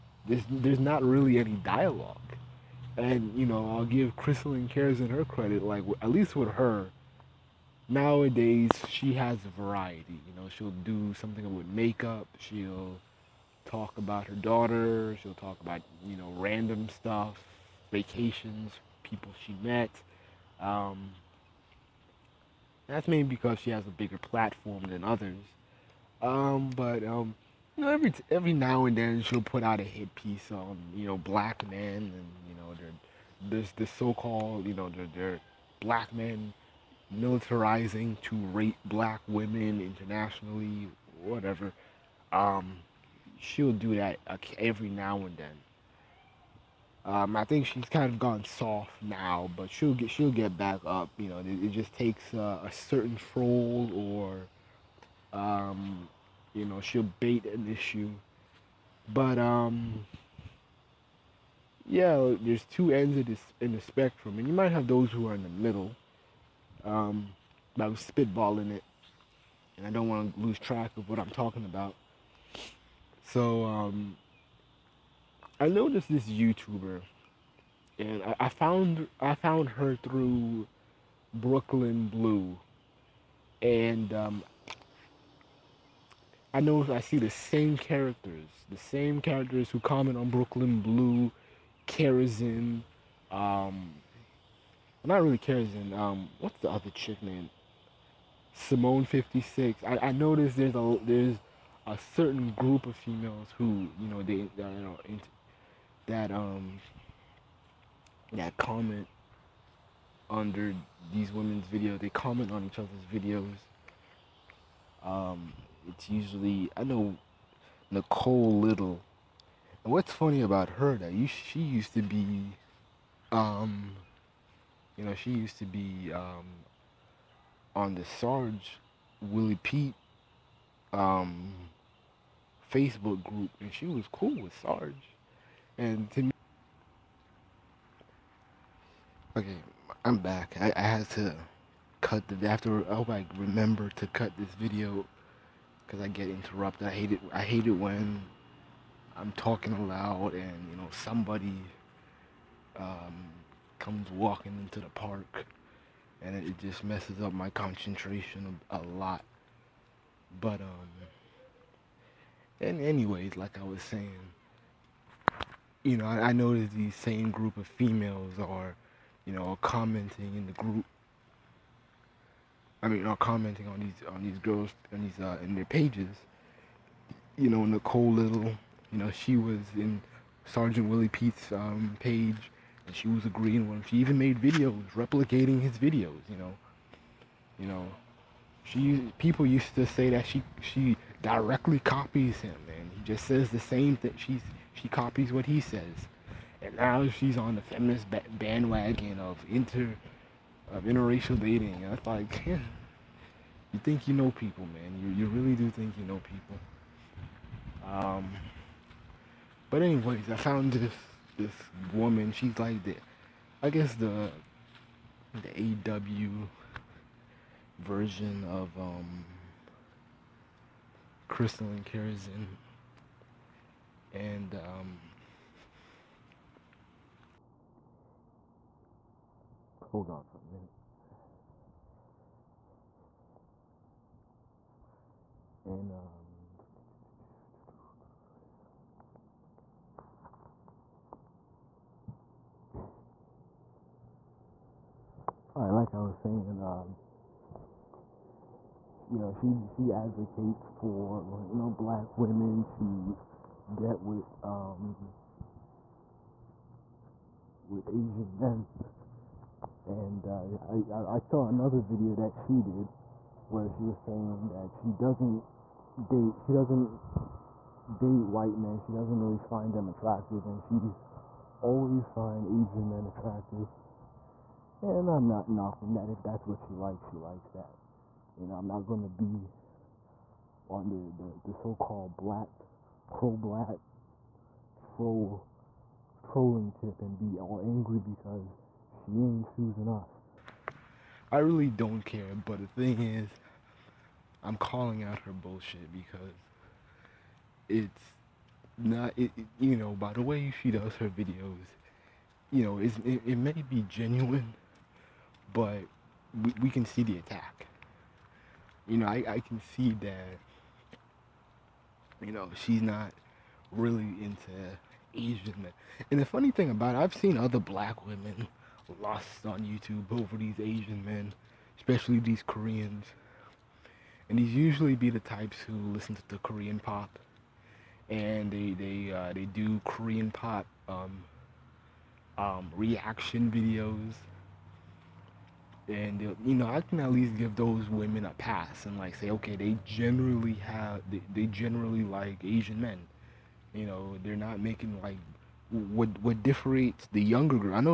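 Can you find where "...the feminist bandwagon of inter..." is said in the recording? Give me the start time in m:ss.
3:17.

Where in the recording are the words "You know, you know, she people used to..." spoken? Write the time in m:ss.
3:06.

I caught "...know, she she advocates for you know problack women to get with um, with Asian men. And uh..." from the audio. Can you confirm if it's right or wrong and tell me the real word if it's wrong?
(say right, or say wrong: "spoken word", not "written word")
wrong: "black", not "problack".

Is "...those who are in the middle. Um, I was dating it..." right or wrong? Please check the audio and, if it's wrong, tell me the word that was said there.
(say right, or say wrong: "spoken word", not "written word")
wrong: "spitballing", not "dating".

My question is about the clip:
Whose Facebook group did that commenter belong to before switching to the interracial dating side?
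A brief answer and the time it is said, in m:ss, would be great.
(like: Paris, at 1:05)
Sarge Willie Pete, at 2:08.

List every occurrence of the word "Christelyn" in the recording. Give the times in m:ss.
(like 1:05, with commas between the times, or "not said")
0:04, 3:41.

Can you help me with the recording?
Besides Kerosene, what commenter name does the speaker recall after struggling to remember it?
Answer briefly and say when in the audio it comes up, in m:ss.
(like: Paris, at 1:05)
Simone Fifty Six, at 1:38.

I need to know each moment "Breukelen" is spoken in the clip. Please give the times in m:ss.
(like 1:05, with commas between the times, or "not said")
1:21, 1:30.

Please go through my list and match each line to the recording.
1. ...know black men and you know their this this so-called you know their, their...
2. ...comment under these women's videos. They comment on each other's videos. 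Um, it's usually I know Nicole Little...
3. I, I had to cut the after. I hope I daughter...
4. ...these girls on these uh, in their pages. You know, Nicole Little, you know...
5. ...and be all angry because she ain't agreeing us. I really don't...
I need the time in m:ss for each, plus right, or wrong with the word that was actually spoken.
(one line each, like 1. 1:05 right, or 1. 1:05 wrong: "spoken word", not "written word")
1. 0:31 right
2. 1:48 right
3. 2:20 wrong: "remember", not "daughter"
4. 2:54 right
5. 4:47 wrong: "choosing", not "agreeing".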